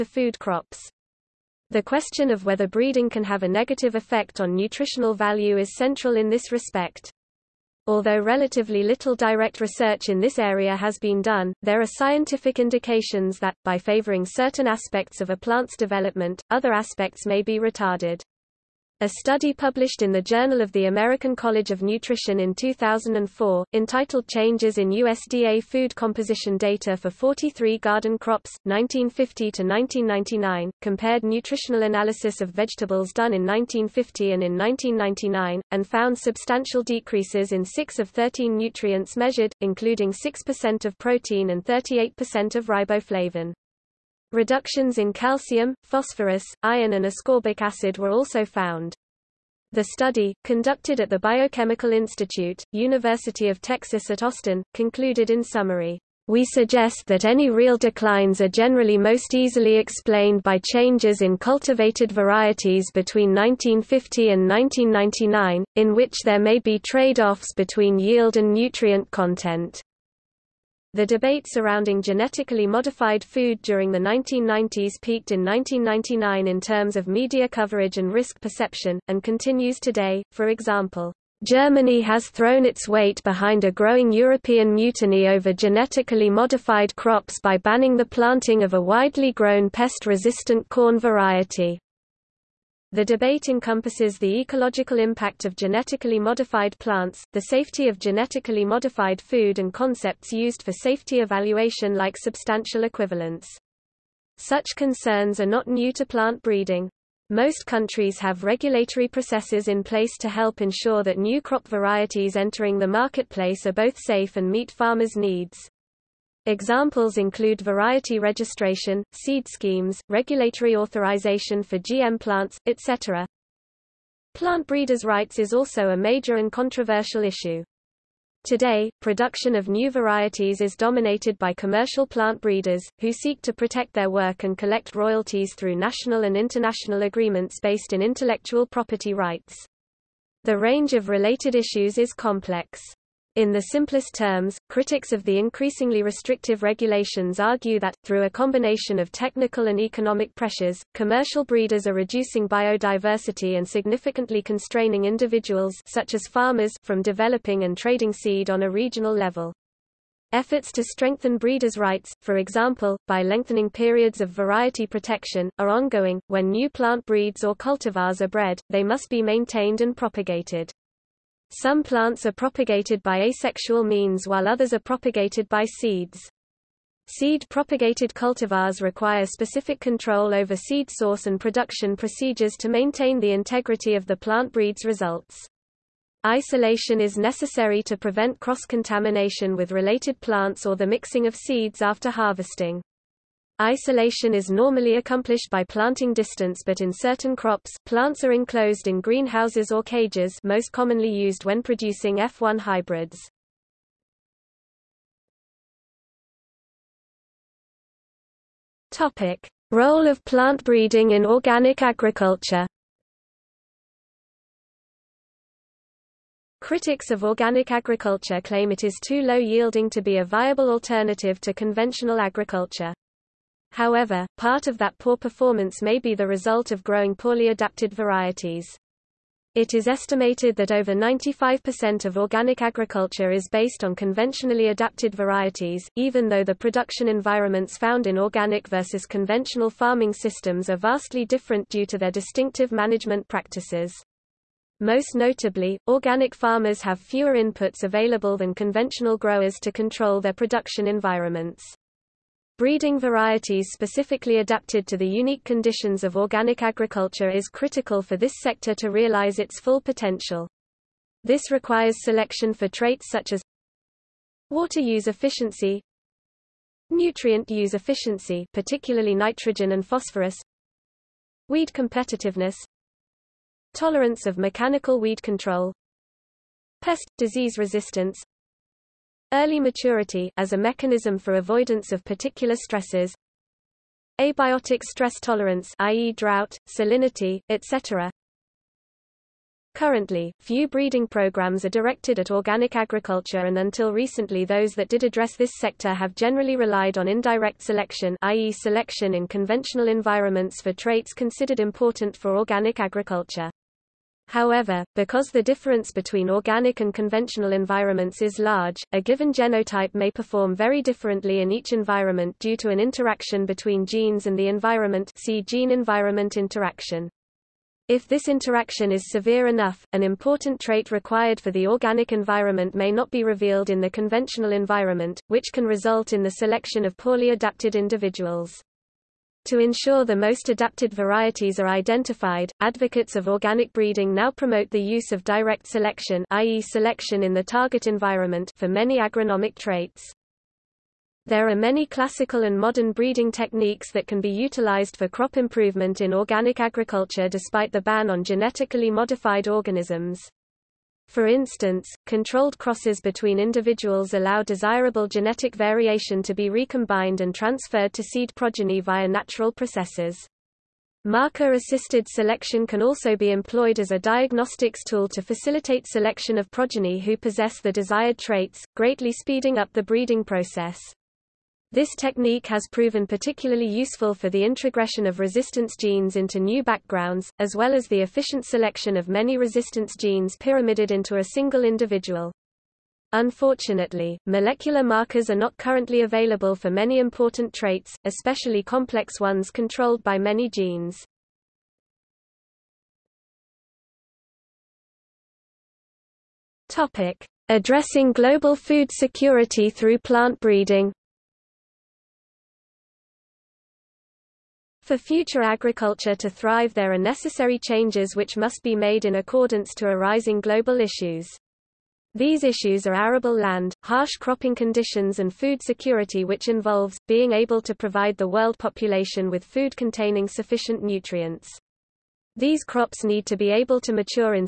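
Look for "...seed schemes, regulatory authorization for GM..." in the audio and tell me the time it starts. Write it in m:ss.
1:59.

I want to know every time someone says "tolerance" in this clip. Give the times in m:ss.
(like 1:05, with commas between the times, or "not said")
4:33, 4:45.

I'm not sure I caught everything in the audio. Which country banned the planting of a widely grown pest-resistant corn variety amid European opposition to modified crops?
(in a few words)
Germany.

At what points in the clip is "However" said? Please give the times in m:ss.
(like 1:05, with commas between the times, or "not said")
3:43, 5:04.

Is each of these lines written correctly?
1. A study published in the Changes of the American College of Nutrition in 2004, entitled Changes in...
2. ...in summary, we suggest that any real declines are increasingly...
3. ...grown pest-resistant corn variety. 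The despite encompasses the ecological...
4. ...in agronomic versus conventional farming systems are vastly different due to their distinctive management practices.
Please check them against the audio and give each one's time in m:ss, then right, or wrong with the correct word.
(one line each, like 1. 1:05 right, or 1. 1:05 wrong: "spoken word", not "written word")
1. 0:19 wrong: "Journal", not "Changes"
2. 0:55 wrong: "generally", not "increasingly"
3. 1:29 wrong: "debate", not "despite"
4. 3:58 wrong: "organic", not "agronomic".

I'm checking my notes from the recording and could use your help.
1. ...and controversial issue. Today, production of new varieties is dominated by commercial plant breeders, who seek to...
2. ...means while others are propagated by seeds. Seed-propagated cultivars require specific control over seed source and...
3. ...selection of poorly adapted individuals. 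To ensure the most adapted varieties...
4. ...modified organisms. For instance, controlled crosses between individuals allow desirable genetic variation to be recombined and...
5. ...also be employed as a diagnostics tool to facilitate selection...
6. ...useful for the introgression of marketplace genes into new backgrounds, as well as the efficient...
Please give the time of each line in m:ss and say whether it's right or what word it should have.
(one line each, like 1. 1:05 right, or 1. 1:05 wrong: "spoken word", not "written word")
1. 2:06 right
2. 2:53 right
3. 5:26 right
4. 5:48 right
5. 6:02 right
6. 6:13 wrong: "resistance", not "marketplace".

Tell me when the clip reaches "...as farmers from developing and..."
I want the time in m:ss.
2:36.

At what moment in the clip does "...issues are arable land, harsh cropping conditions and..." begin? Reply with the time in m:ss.
6:52.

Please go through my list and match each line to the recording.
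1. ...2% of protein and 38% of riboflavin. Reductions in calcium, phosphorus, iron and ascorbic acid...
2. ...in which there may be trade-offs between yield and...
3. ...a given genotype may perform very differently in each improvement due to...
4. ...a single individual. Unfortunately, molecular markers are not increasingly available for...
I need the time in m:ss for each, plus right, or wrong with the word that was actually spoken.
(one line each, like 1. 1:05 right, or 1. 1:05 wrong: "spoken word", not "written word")
1. 0:40 wrong: "6", not "2"
2. 1:05 right
3. 5:08 wrong: "environment", not "improvement"
4. 6:21 wrong: "currently", not "increasingly".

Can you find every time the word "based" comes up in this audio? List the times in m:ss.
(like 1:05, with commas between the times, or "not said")
2:17, 3:53.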